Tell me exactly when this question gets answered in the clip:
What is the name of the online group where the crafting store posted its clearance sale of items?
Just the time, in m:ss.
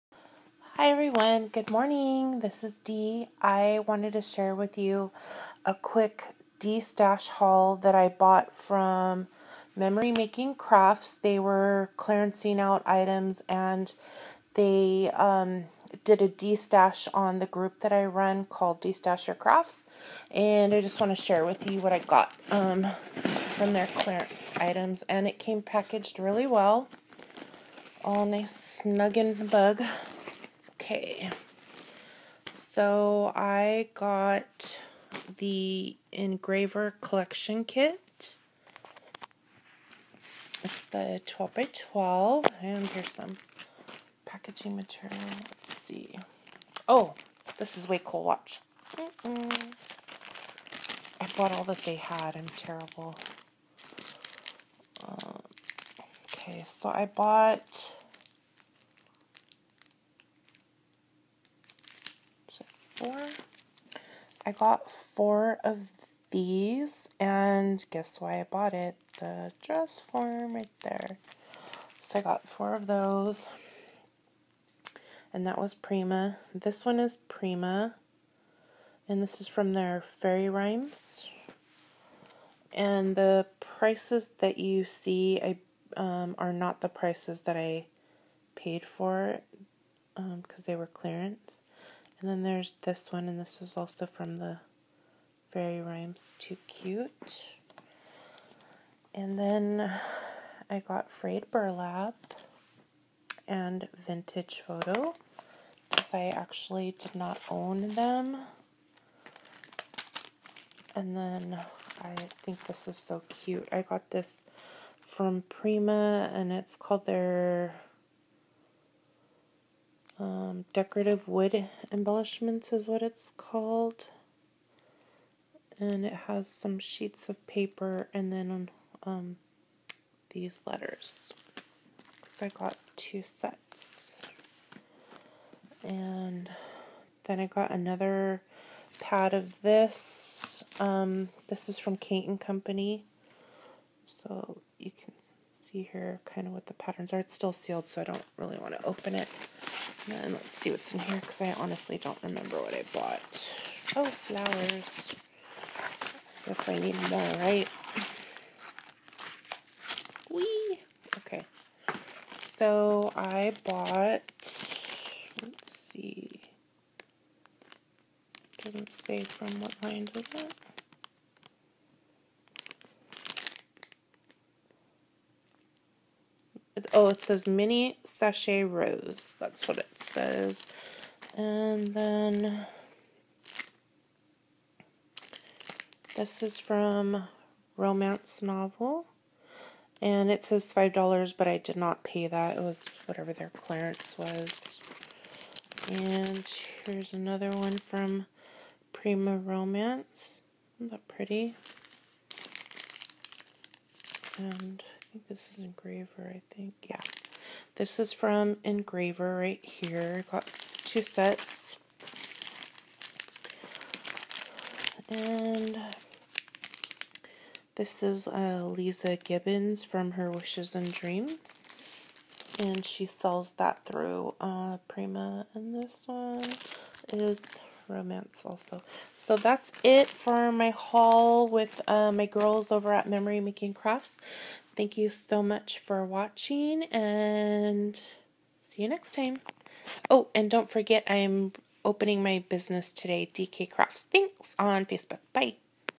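0:18.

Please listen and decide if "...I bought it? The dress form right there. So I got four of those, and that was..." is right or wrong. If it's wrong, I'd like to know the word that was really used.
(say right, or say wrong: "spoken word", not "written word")
right.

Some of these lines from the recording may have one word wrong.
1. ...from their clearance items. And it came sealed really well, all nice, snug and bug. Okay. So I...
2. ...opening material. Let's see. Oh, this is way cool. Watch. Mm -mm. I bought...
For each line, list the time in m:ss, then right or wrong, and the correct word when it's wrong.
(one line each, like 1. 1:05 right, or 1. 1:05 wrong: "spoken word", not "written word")
1. 0:22 wrong: "packaged", not "sealed"
2. 0:44 wrong: "packaging", not "opening".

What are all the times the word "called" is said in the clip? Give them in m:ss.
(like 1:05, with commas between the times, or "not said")
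0:18, 1:56, 2:03.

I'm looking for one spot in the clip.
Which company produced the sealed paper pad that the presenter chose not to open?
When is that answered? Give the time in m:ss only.
2:21.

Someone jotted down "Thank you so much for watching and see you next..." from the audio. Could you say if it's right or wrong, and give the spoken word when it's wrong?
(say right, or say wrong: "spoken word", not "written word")
right.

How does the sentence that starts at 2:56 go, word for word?
oh, it says mini sachet rose.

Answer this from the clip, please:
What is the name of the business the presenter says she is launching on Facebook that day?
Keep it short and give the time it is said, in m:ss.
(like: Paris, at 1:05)
DK Crafts, at 4:03.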